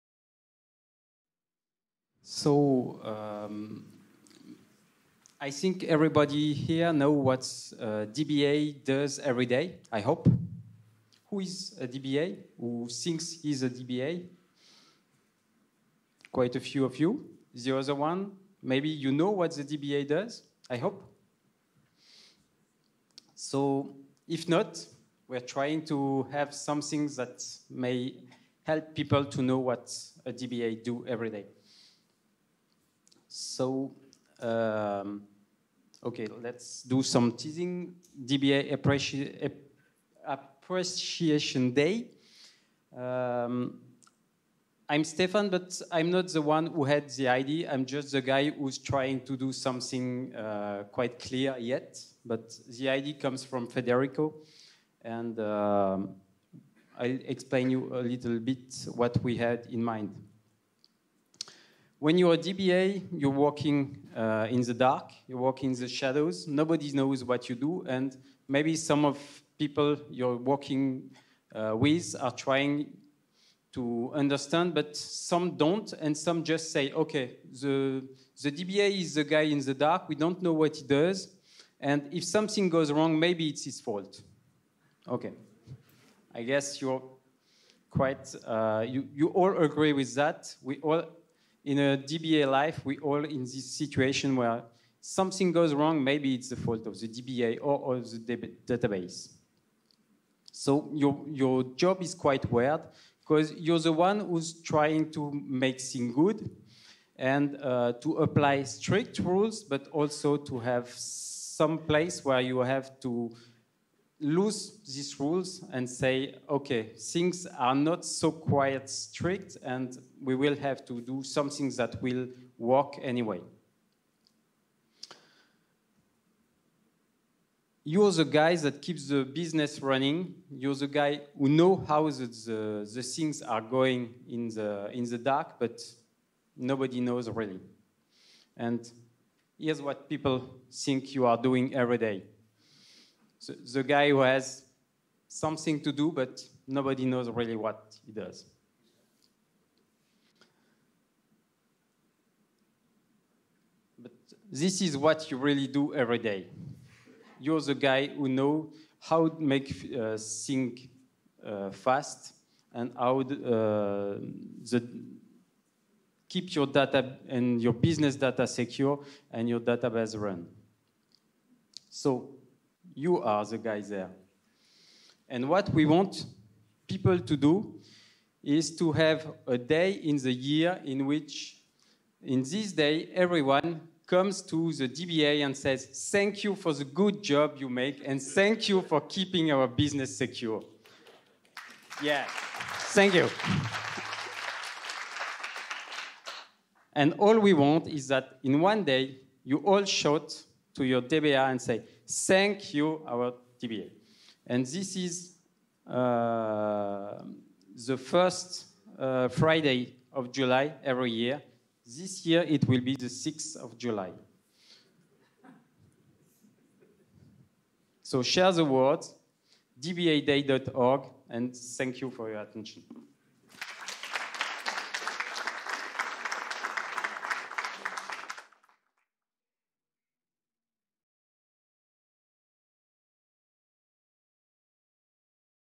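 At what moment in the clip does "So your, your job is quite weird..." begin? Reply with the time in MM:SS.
01:40.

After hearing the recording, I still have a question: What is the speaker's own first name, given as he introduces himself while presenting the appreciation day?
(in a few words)
Stéphane.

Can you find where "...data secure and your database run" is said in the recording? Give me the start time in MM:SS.
02:48.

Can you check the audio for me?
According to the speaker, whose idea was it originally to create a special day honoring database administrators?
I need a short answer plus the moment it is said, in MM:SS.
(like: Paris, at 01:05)
Federico, at 00:53.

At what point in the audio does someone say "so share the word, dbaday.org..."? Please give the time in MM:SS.
03:38.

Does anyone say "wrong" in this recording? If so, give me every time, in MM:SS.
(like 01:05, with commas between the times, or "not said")
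01:22, 01:35.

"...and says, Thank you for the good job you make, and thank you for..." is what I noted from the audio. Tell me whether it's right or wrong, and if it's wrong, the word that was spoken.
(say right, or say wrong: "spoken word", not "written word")
right.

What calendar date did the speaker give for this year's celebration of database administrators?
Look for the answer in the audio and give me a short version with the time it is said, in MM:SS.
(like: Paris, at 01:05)
6th of July, at 03:33.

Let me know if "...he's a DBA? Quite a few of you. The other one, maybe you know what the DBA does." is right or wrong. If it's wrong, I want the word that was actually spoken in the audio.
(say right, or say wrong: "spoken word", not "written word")
right.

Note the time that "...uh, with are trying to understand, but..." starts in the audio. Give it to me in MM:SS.
01:11.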